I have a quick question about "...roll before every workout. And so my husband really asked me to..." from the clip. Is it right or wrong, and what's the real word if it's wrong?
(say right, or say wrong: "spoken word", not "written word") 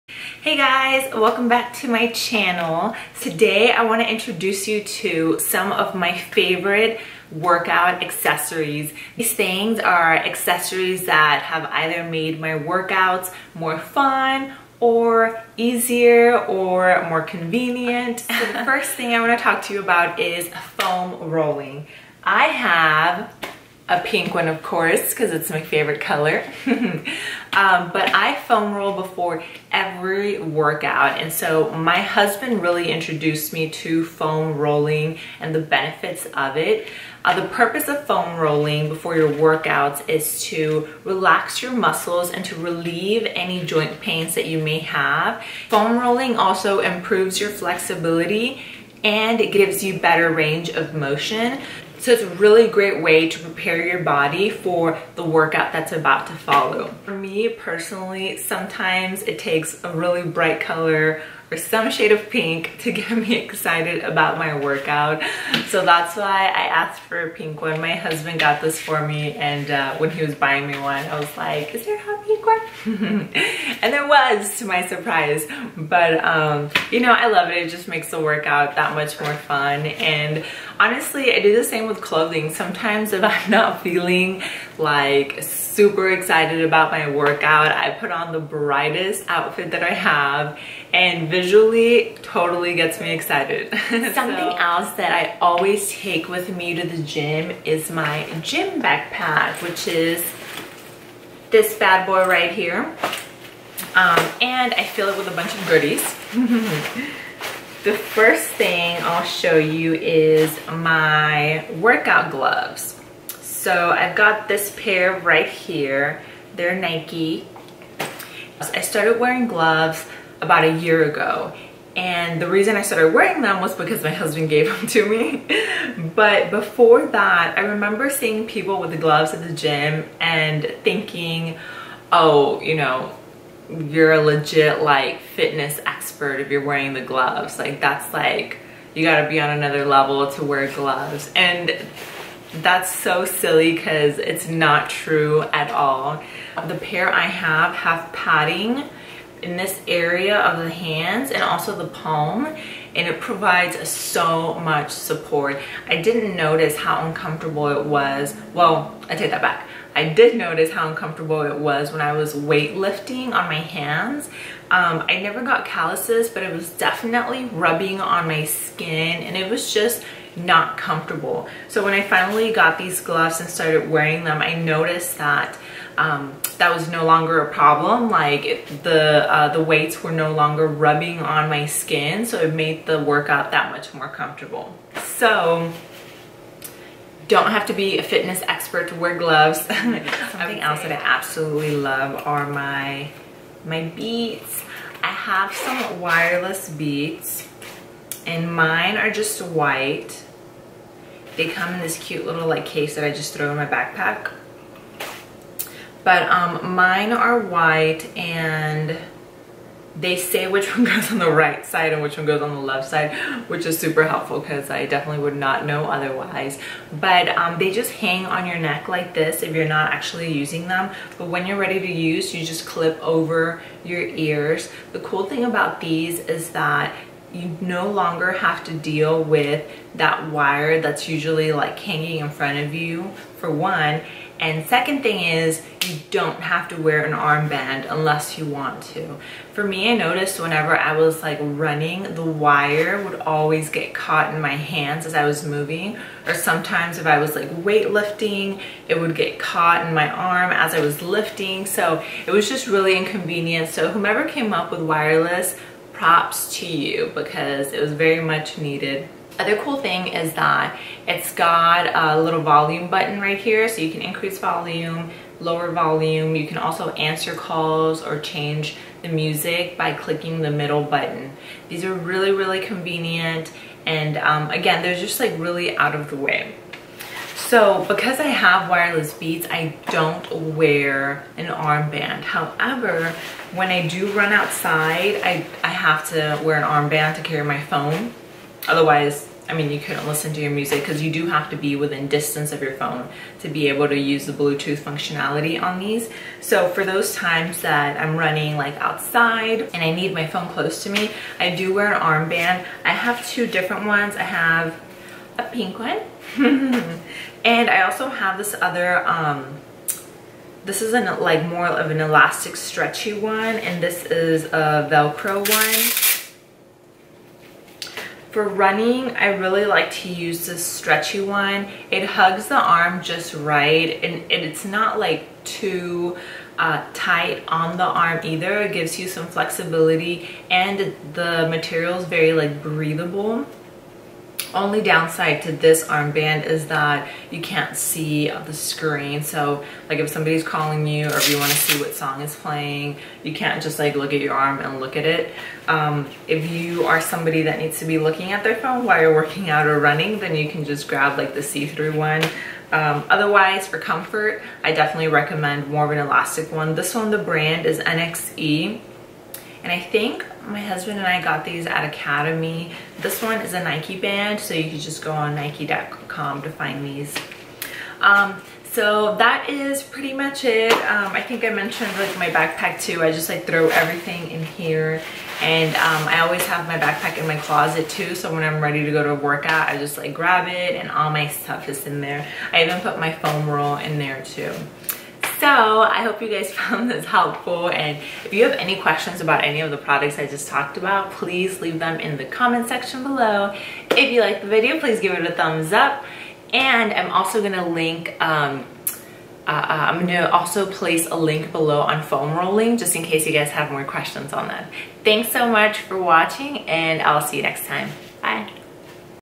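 wrong: "introduced", not "asked".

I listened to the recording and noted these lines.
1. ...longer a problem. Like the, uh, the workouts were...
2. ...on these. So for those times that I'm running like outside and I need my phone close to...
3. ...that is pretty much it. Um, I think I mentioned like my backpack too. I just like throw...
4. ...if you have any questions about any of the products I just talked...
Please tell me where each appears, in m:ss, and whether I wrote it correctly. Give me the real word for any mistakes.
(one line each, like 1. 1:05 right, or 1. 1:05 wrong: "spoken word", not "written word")
1. 2:57 wrong: "weights", not "workouts"
2. 4:55 right
3. 6:09 right
4. 6:28 right.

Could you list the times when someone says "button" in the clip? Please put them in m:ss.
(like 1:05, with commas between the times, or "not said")
4:22, 4:30.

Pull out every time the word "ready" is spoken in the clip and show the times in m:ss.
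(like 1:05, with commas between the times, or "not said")
3:41, 6:18.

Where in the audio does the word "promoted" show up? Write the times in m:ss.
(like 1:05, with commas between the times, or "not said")
not said.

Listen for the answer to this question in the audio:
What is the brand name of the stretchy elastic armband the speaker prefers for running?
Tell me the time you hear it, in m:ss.
5:57.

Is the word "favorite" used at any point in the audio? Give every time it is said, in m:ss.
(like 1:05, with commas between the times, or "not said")
0:06, 0:25.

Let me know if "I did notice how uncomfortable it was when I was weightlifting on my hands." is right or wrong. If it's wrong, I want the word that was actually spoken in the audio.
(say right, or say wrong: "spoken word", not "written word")
right.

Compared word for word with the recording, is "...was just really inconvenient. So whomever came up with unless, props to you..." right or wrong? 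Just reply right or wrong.
wrong.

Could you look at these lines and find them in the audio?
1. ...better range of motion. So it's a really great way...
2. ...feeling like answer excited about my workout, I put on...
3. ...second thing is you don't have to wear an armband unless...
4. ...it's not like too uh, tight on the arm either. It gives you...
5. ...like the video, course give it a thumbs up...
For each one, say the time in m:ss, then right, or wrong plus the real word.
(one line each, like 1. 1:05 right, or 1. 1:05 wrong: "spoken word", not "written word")
1. 0:49 right
2. 1:23 wrong: "super", not "answer"
3. 3:54 right
4. 5:24 right
5. 6:34 wrong: "please", not "course".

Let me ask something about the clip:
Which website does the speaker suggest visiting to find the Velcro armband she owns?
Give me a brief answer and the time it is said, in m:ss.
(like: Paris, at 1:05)
nike.com, at 6:05.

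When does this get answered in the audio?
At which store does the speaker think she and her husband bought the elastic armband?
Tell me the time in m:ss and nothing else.
6:01.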